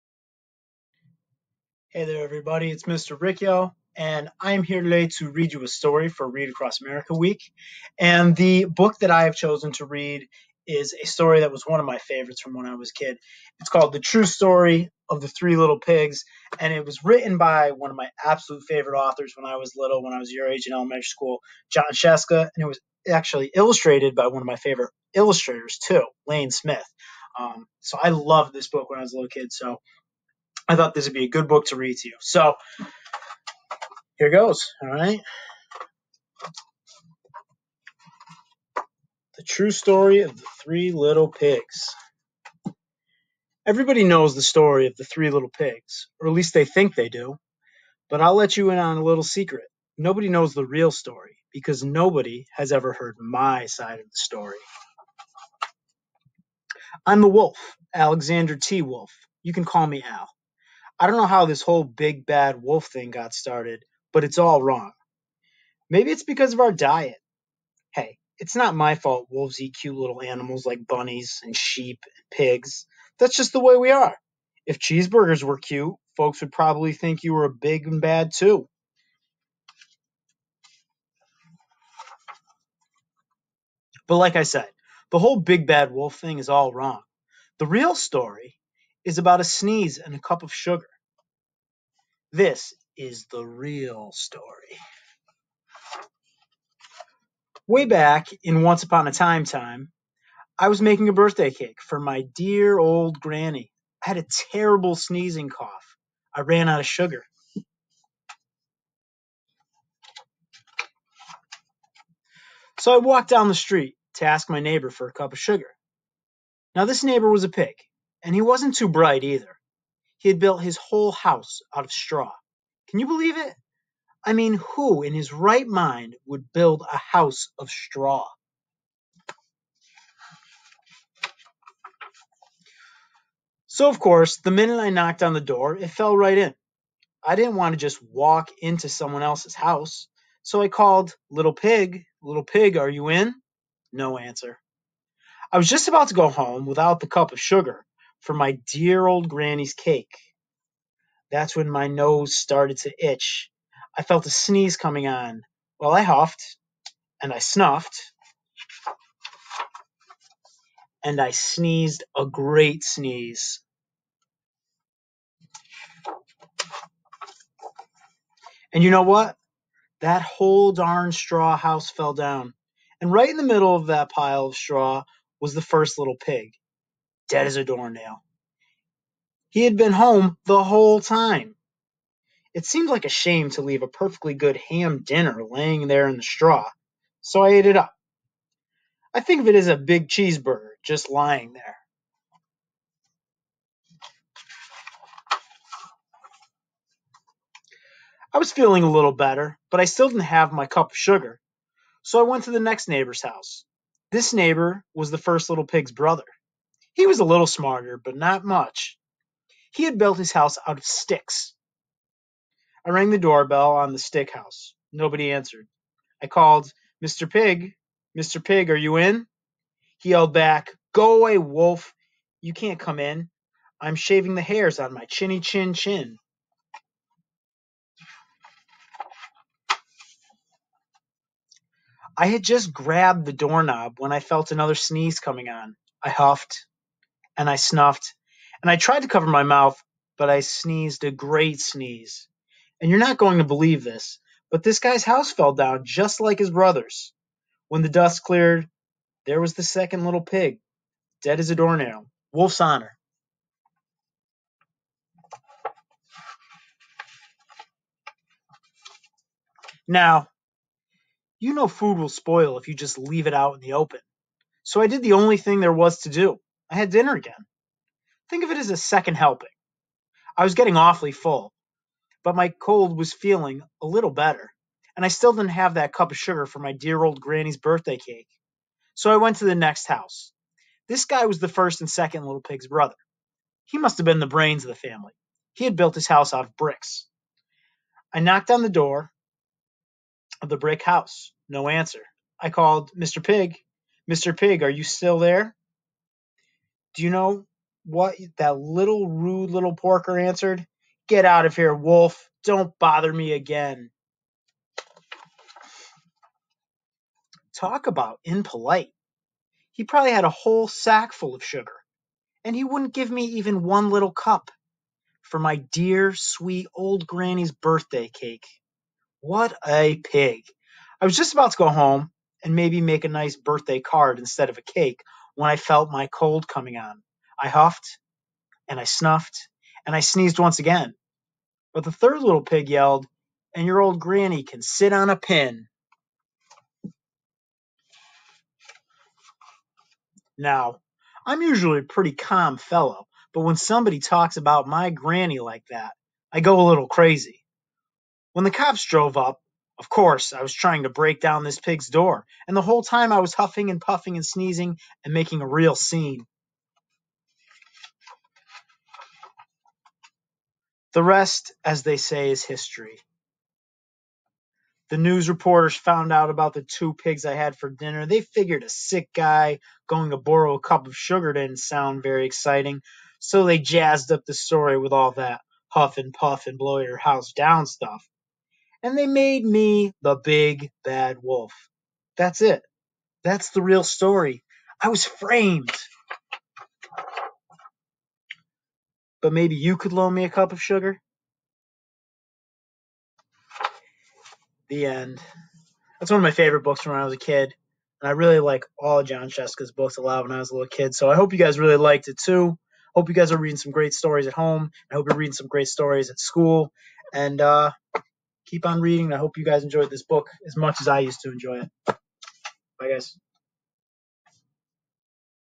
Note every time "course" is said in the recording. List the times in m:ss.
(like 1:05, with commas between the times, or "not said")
2:13, 5:49.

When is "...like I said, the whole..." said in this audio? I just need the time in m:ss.
1:24.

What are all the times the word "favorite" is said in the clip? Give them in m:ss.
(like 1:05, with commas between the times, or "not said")
0:11, 0:18, 0:24, 6:36.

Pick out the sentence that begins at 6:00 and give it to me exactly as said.
The rest, as they say, is history.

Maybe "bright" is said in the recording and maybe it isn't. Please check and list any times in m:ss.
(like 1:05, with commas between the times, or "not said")
1:58.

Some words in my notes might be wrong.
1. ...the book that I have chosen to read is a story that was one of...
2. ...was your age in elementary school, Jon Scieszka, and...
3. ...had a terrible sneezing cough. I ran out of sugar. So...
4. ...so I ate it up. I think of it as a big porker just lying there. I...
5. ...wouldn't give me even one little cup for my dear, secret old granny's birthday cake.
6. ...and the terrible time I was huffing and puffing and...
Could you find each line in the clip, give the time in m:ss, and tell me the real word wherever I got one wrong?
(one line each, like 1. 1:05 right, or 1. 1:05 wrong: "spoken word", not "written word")
1. 0:08 right
2. 0:20 right
3. 1:44 right
4. 3:07 wrong: "cheeseburger", not "porker"
5. 5:12 wrong: "sweet", not "secret"
6. 5:52 wrong: "whole", not "terrible".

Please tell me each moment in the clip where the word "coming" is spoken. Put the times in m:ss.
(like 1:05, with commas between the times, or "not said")
2:34, 3:55, 5:26.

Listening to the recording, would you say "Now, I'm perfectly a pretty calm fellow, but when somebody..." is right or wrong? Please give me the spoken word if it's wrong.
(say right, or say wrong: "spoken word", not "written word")
wrong: "usually", not "perfectly".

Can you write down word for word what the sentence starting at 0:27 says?
Um, so I loved this book when I was a little kid.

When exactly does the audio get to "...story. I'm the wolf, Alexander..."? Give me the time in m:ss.
0:54.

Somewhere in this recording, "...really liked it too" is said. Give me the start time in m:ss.
6:41.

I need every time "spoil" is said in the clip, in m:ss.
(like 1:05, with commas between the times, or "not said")
4:22.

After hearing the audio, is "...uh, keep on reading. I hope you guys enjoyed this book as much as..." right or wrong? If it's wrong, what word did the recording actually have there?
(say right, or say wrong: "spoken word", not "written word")
right.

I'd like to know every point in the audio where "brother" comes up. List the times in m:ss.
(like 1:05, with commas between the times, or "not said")
3:25, 4:06, 4:42.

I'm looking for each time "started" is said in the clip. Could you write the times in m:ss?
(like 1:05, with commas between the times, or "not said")
1:03, 2:32.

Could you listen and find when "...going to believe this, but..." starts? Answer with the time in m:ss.
4:03.